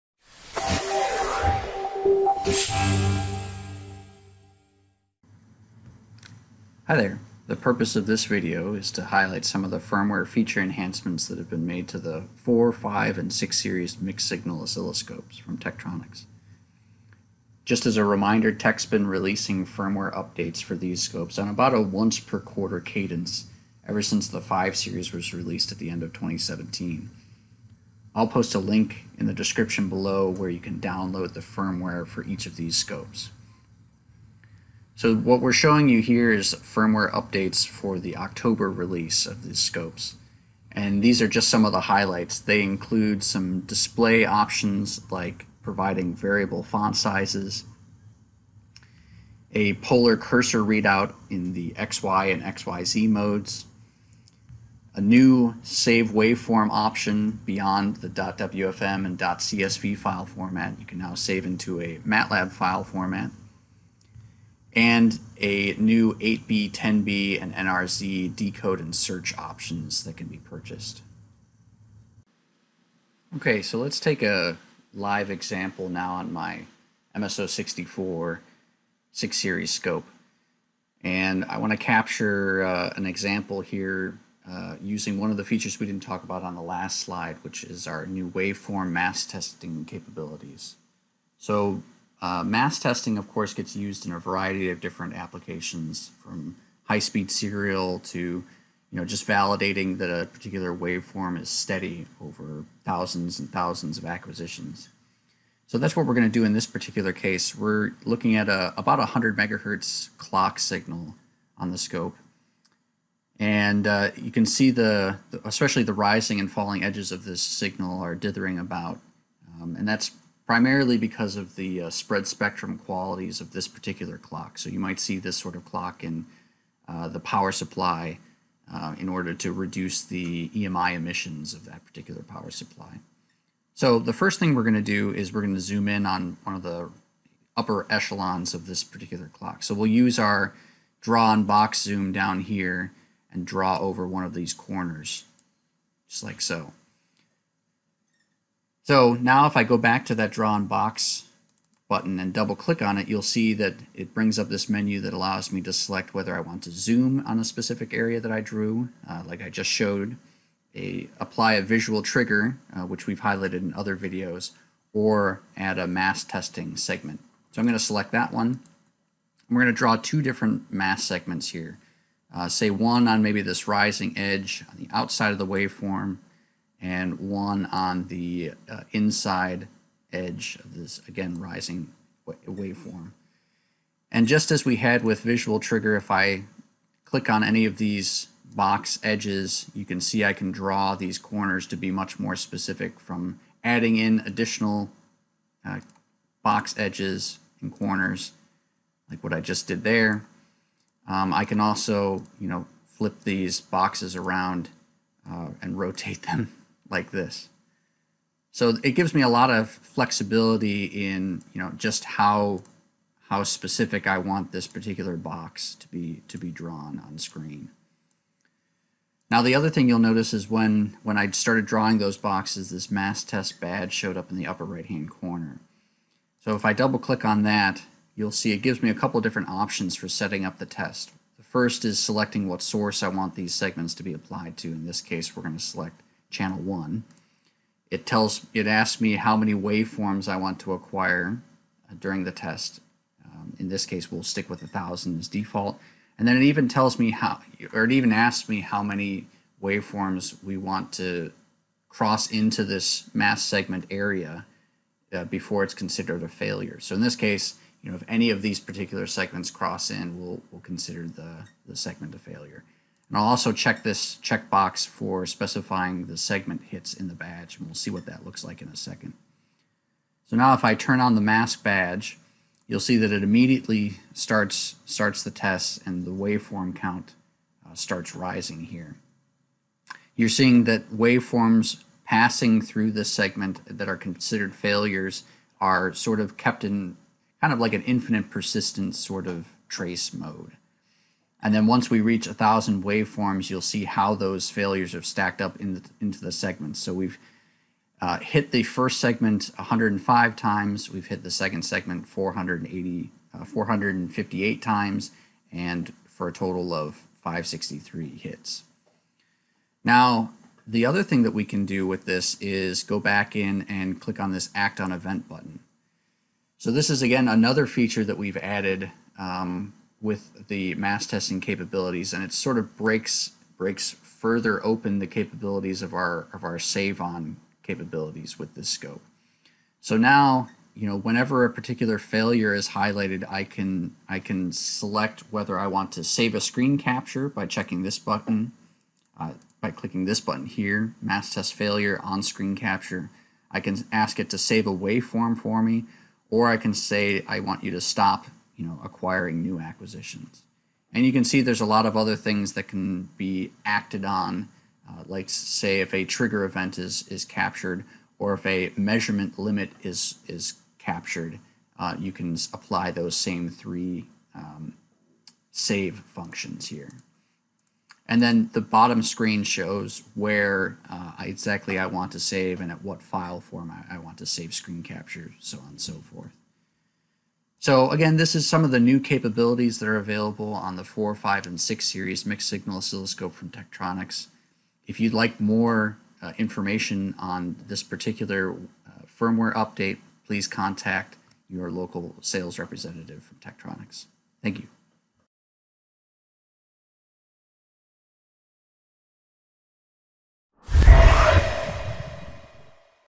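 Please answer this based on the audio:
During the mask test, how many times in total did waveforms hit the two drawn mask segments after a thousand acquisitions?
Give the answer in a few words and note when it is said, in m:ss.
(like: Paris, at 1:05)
563, at 5:07.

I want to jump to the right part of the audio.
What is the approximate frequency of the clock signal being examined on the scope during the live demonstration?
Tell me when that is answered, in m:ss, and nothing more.
1:48.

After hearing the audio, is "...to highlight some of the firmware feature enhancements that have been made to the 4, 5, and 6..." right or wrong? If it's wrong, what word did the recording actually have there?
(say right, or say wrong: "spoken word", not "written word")
right.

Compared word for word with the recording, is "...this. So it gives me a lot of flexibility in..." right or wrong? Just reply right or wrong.
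right.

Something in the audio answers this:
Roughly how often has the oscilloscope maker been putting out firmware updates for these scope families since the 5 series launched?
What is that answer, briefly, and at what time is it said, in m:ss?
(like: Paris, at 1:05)
Once per quarter, at 0:21.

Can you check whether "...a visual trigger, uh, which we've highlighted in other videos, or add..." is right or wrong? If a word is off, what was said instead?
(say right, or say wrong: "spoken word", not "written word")
right.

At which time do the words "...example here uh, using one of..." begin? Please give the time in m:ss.
1:23.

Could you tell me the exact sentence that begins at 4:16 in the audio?
So in this case, you know, if any of these particular segments cross in, we'll, we'll consider the, the segment a failure.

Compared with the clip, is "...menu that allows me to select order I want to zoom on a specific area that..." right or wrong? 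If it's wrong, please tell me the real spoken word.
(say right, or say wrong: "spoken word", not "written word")
wrong: "whether", not "order".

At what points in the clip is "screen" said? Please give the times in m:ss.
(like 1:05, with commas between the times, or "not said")
3:37, 5:36, 5:42, 6:09, 6:14.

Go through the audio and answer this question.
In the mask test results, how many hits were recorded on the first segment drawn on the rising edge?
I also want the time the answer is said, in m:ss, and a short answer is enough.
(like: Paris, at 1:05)
105, at 4:59.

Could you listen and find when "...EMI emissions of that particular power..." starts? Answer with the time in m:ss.
2:10.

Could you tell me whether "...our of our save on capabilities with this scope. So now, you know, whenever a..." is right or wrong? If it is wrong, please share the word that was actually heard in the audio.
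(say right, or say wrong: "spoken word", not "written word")
right.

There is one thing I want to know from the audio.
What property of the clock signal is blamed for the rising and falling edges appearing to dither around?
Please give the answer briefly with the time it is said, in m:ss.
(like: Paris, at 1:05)
Spread spectrum, at 2:01.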